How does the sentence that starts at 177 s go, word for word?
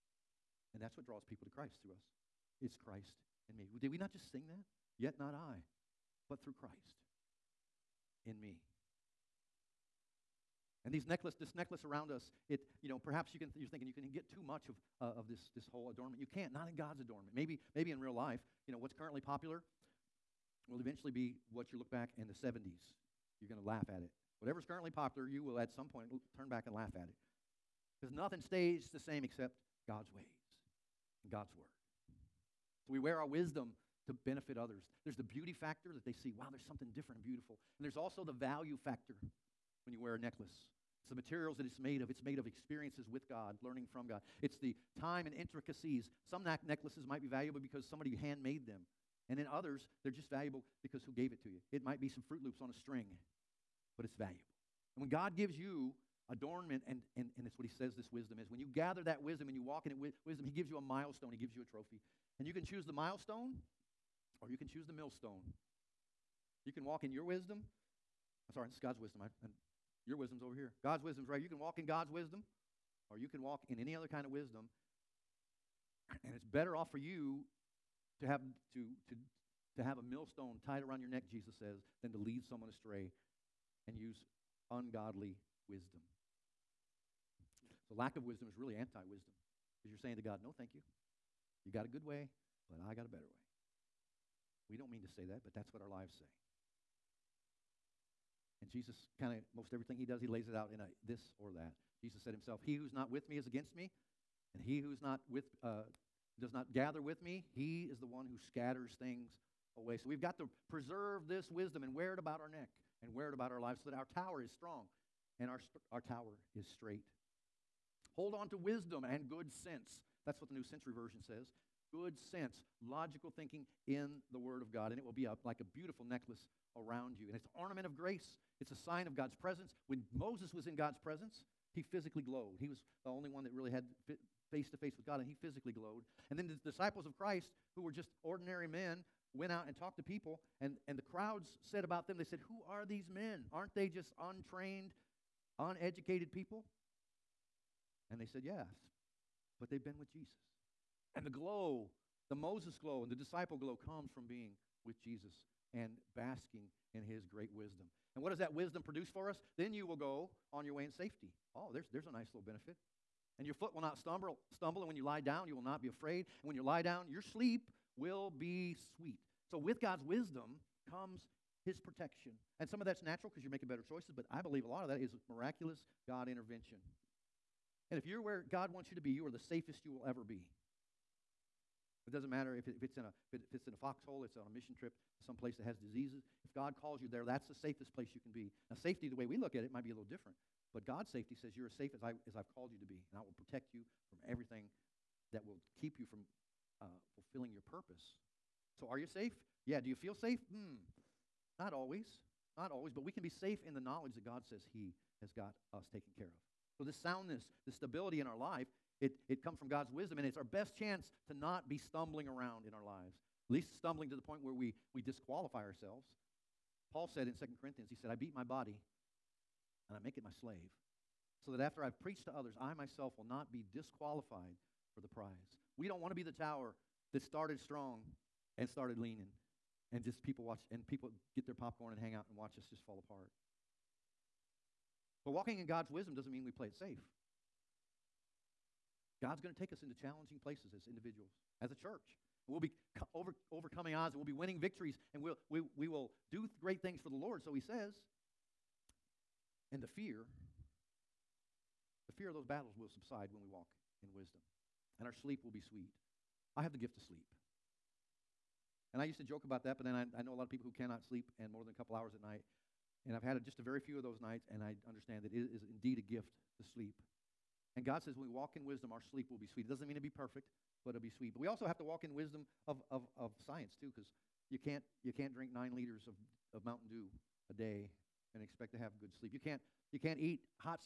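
And if you're where God wants you to be, you are the safest you will ever be.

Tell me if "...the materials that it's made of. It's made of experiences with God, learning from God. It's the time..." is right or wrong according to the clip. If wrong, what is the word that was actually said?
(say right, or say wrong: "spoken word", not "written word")
right.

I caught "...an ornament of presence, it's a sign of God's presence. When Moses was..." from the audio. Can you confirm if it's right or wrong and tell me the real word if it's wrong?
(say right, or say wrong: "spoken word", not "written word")
wrong: "grace", not "presence".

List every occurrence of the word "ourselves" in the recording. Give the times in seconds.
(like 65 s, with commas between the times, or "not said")
215 s.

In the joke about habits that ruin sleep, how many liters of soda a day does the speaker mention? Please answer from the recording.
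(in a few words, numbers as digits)
9.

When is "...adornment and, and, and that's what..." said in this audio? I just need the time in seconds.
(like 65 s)
56 s.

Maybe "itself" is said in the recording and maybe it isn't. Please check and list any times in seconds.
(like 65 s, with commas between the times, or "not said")
not said.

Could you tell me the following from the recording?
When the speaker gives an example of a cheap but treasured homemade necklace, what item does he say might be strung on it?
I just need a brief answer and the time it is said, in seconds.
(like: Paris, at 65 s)
Froot Loops, at 52 s.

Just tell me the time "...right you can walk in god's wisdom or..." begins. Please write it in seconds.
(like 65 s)
71 s.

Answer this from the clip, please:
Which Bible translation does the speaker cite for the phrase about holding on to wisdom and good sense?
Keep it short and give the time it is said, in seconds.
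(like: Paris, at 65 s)
New Century Version, at 120 s.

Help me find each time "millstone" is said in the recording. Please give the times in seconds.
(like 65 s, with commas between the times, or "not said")
64 s, 80 s.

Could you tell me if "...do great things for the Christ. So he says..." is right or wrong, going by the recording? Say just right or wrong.
wrong.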